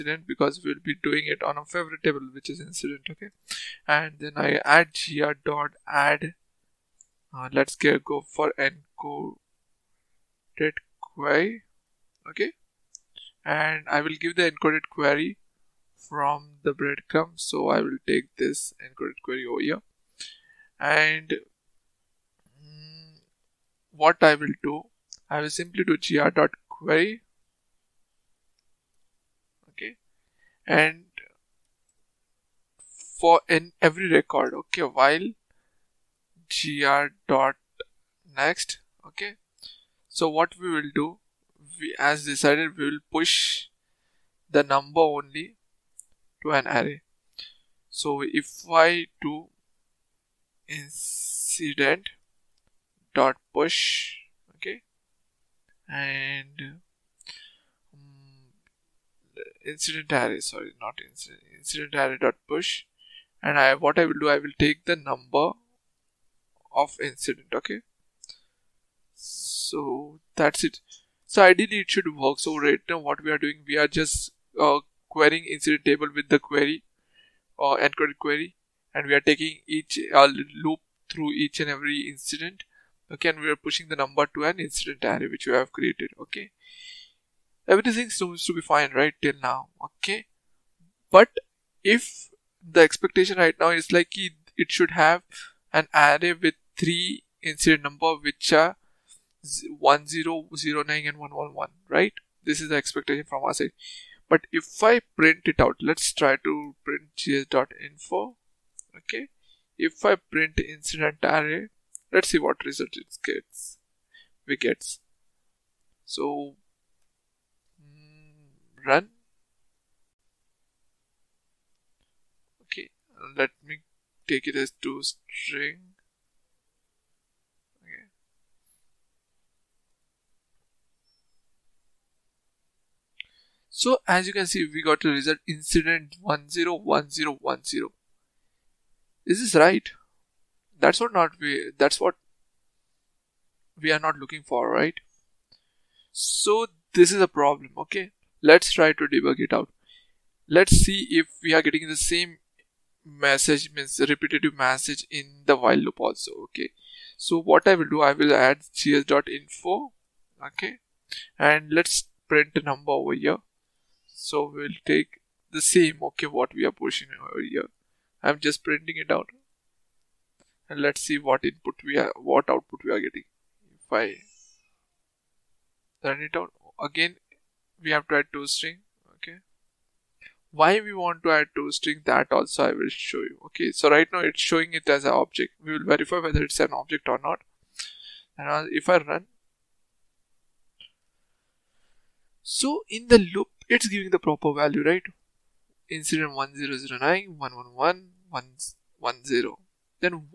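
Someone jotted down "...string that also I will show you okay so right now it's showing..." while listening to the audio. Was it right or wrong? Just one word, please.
right.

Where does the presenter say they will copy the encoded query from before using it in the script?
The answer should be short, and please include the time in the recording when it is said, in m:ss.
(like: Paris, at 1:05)
the breadcrumb, at 0:16.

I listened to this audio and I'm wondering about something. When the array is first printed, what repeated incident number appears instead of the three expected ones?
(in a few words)
101010.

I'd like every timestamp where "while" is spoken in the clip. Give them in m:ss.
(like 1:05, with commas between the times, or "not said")
0:34, 2:35.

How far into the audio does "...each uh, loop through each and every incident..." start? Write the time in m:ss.
1:19.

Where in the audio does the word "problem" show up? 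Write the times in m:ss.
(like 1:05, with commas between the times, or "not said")
2:27.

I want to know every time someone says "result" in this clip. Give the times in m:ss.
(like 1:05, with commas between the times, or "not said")
1:52, 2:15.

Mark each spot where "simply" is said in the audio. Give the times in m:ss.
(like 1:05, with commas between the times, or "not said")
0:25.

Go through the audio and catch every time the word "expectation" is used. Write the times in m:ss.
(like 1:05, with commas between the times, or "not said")
1:32, 1:42.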